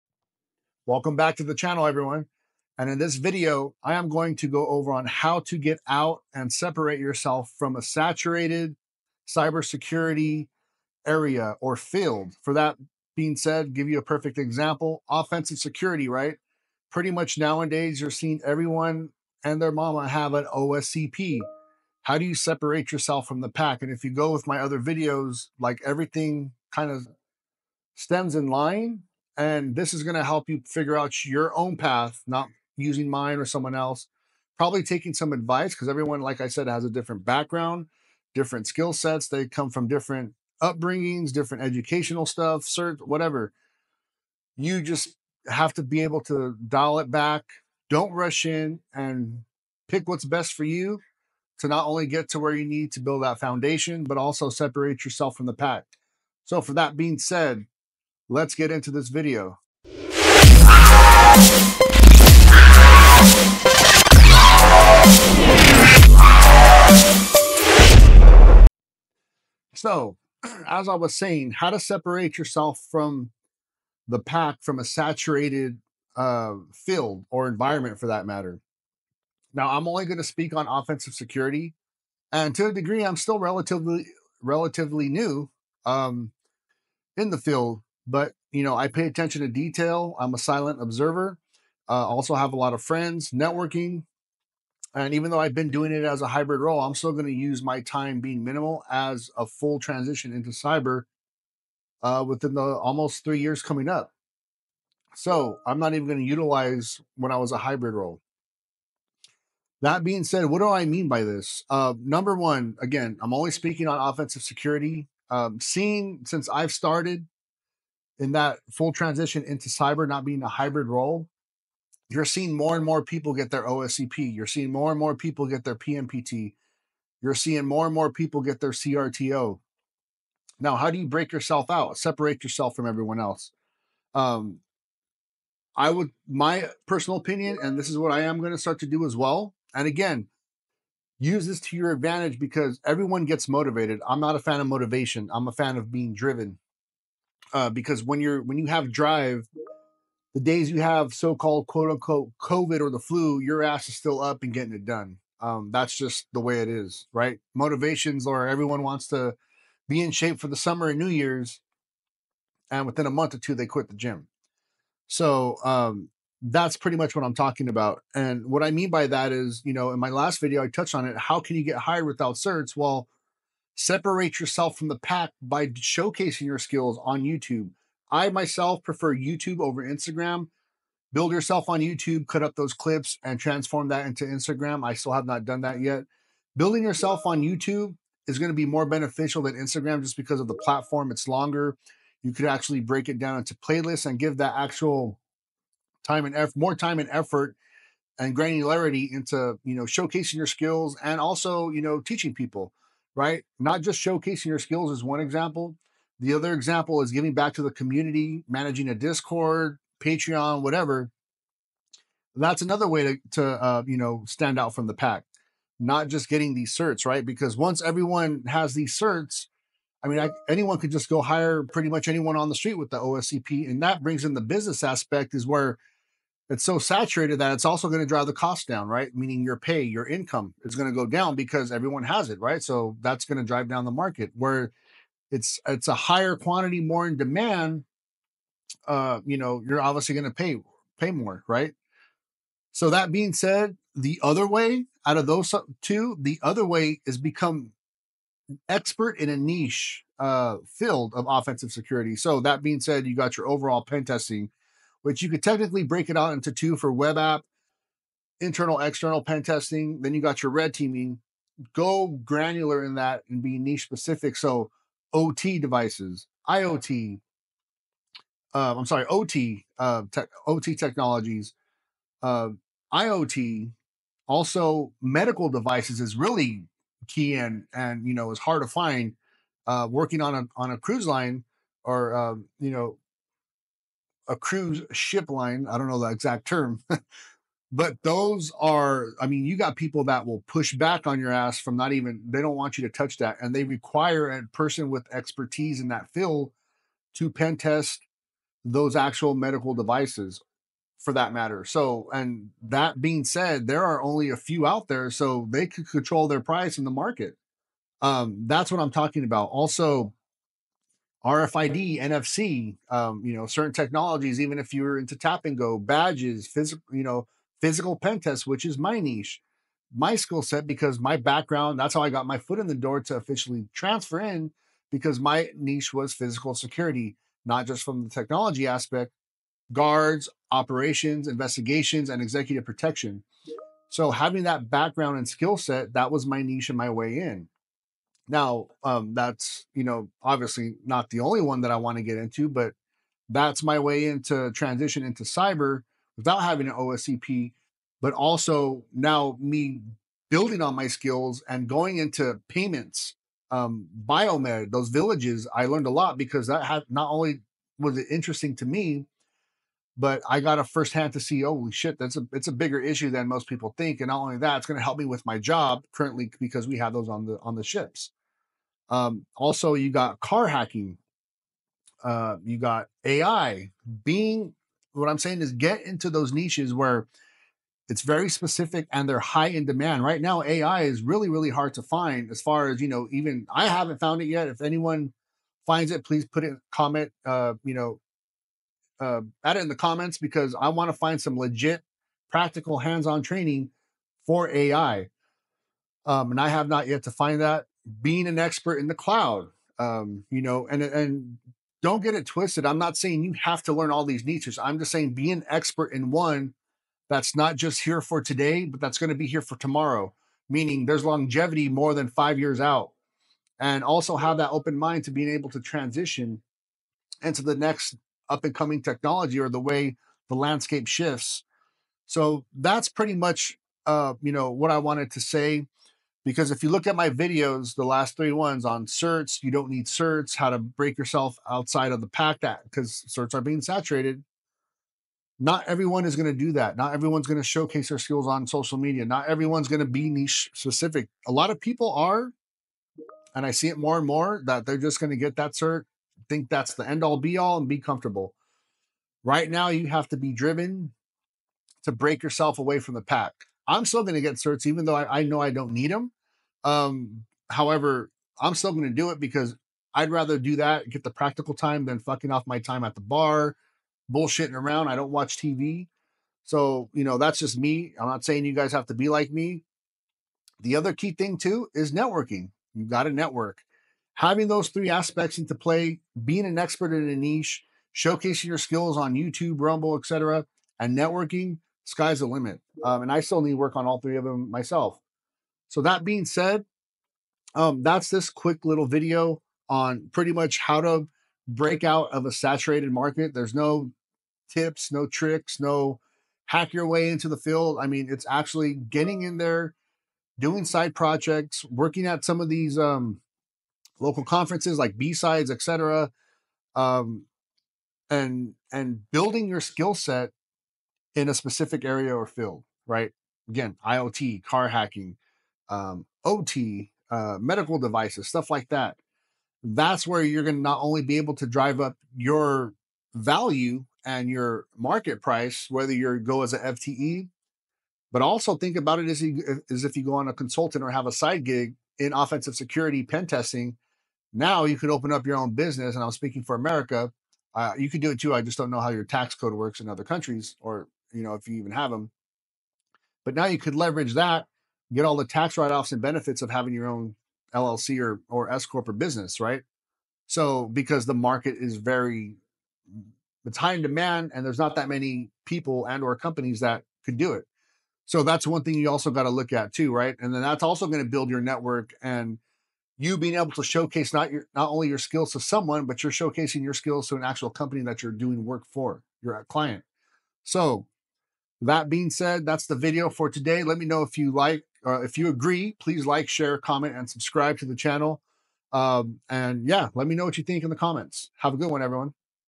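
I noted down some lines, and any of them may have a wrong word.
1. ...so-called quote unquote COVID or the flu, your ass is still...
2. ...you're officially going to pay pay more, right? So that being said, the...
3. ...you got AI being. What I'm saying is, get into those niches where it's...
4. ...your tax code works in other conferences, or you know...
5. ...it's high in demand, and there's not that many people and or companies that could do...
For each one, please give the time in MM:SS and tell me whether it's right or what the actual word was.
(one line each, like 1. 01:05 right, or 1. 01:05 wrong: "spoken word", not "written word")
1. 02:31 right
2. 03:59 wrong: "obviously", not "officially"
3. 06:12 right
4. 08:58 wrong: "countries", not "conferences"
5. 09:13 right.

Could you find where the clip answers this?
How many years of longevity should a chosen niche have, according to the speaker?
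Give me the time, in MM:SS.
06:51.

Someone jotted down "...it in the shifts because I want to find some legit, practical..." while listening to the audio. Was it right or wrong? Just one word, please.
wrong.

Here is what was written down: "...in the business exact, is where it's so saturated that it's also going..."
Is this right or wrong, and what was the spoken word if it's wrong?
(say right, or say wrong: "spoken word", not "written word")
wrong: "aspect", not "exact".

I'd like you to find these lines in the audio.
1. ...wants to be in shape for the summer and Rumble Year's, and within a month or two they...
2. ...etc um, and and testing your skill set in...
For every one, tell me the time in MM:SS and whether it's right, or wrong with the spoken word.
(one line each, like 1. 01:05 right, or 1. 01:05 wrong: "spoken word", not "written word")
1. 02:38 wrong: "New", not "Rumble"
2. 08:25 wrong: "building", not "testing".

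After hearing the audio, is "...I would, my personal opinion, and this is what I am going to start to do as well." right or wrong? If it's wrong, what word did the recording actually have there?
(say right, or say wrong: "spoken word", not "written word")
right.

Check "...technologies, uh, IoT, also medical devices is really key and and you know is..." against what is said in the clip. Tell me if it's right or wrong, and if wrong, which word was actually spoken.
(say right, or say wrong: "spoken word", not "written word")
right.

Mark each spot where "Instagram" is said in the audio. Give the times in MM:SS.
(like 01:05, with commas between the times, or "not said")
02:59, 03:04, 03:09.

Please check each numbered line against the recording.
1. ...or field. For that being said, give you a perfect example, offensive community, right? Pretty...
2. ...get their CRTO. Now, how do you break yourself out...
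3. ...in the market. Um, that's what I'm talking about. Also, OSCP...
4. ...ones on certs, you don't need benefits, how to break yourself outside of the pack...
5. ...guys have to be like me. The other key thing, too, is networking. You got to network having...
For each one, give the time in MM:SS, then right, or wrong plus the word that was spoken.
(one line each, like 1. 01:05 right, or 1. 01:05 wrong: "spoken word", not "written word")
1. 00:11 wrong: "security", not "community"
2. 02:08 right
3. 05:06 wrong: "RFID", not "OSCP"
4. 07:08 wrong: "certs", not "benefits"
5. 07:48 right.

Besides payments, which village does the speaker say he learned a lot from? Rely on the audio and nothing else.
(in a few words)
biomed.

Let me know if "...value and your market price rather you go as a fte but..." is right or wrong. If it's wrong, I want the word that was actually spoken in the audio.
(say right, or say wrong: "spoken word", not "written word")
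wrong: "whether", not "rather".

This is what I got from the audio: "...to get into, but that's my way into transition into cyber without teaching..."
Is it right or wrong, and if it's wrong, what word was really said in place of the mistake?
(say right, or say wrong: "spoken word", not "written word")
wrong: "having", not "teaching".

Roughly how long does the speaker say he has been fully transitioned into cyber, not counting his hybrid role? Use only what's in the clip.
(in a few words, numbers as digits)
almost 3 years.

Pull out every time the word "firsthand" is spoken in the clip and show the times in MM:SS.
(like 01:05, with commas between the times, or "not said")
06:00.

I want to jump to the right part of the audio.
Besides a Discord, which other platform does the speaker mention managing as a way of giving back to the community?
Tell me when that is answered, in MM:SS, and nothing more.
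03:29.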